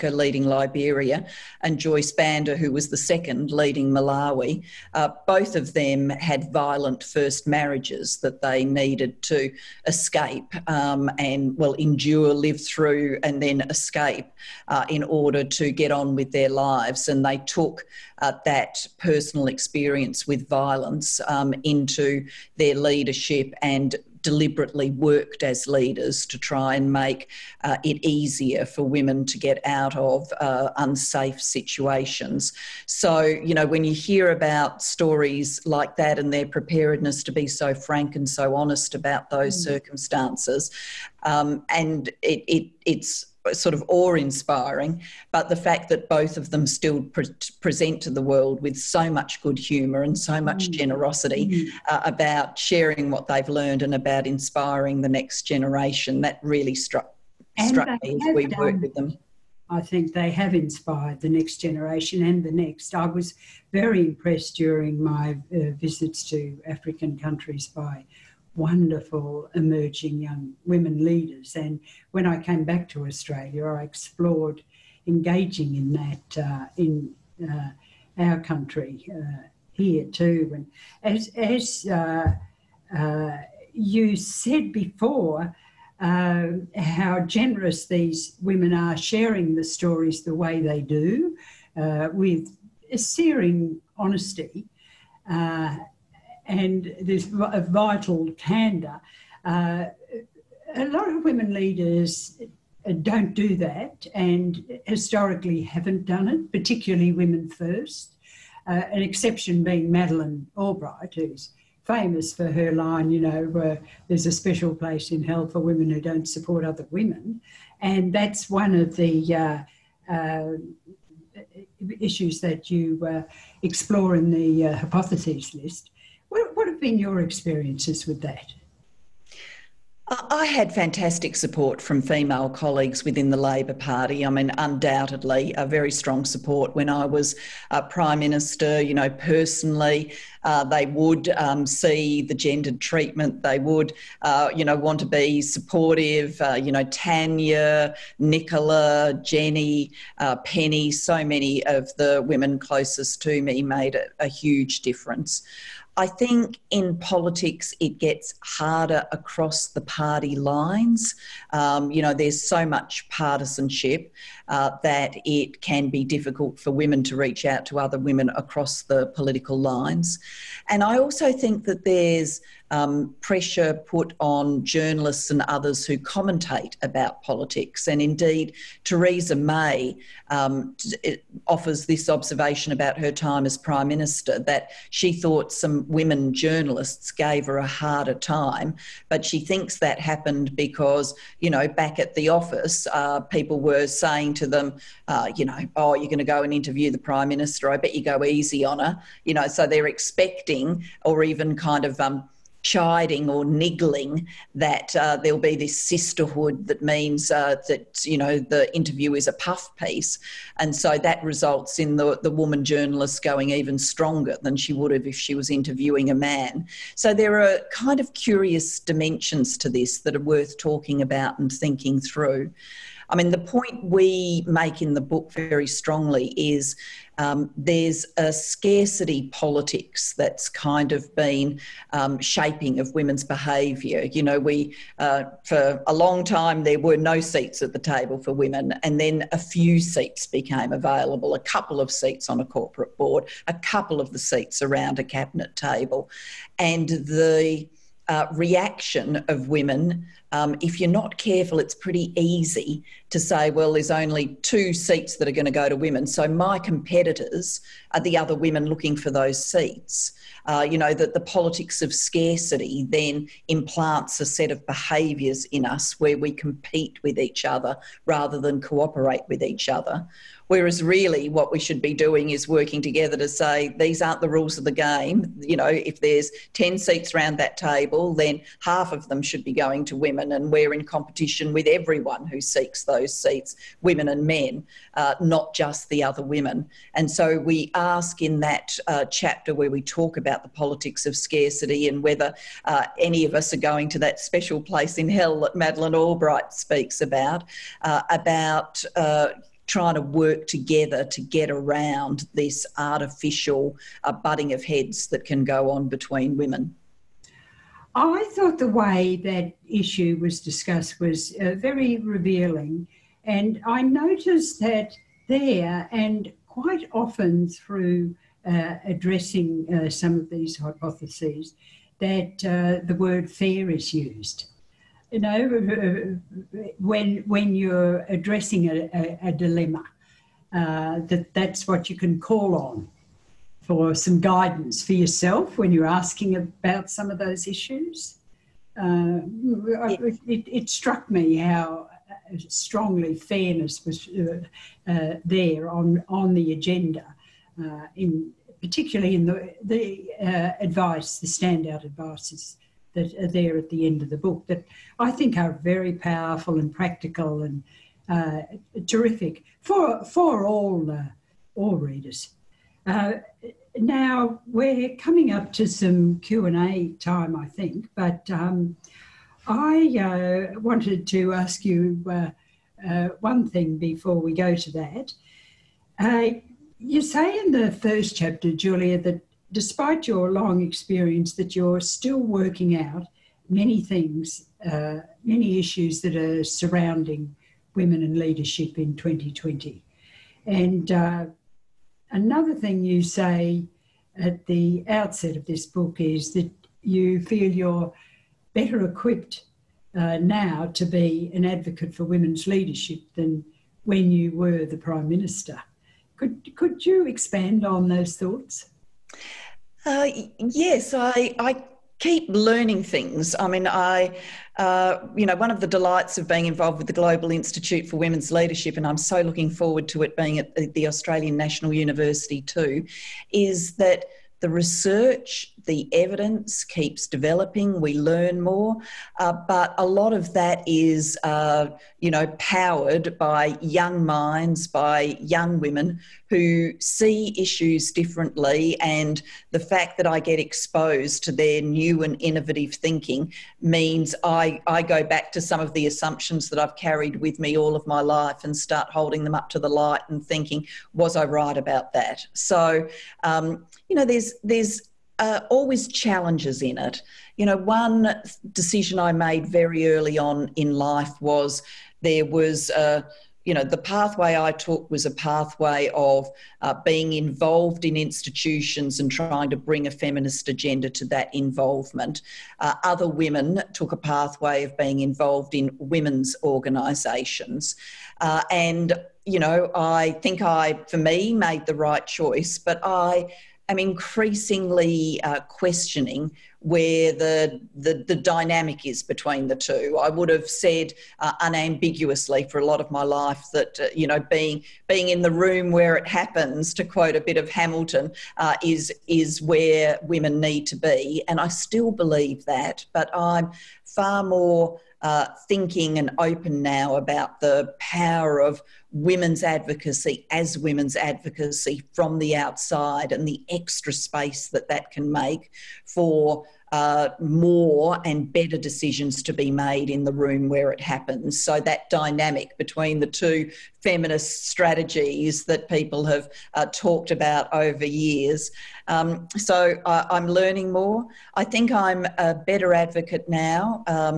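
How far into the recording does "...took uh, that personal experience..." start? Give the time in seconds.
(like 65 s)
17 s.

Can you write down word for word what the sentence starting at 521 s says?
So, that dynamic between the two feminist strategies that people have uh, talked about over years.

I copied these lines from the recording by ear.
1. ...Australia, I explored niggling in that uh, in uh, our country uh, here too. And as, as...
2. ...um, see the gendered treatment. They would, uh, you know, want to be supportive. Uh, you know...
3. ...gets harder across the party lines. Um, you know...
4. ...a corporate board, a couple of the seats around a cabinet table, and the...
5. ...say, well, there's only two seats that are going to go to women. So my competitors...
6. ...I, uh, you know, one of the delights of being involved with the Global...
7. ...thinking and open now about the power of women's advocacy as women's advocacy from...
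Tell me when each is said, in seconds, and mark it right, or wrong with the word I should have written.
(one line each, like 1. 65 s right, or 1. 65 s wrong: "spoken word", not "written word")
1. 73 s wrong: "engaging", not "niggling"
2. 141 s right
3. 157 s right
4. 242 s right
5. 253 s right
6. 413 s right
7. 505 s right.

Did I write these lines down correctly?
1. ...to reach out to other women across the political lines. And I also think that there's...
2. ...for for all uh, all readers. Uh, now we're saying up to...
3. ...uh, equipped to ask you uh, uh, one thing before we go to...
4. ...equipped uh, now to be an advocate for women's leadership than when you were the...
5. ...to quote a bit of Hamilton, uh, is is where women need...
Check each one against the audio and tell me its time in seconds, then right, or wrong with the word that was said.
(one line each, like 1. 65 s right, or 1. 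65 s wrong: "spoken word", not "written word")
1. 167 s right
2. 359 s wrong: "coming", not "saying"
3. 370 s wrong: "wanted", not "equipped"
4. 398 s right
5. 496 s right.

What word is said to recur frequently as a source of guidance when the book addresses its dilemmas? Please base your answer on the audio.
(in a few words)
fair.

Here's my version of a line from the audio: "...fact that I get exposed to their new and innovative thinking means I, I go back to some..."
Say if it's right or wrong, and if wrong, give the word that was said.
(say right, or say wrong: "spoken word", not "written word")
right.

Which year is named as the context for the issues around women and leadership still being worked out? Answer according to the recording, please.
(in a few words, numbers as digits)
2020.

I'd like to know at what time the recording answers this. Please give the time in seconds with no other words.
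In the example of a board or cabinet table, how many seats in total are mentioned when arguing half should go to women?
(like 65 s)
276 s.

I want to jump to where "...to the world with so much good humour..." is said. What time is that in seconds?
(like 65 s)
48 s.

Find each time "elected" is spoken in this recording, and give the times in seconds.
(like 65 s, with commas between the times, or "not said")
not said.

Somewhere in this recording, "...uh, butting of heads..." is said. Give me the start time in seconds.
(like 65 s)
304 s.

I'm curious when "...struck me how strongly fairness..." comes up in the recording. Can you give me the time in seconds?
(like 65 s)
340 s.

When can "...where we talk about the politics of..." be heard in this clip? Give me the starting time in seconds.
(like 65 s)
289 s.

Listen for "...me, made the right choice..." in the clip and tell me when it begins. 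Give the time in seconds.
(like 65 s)
480 s.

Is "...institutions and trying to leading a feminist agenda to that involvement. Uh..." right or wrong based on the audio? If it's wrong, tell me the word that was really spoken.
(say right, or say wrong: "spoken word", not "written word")
wrong: "bring", not "leading".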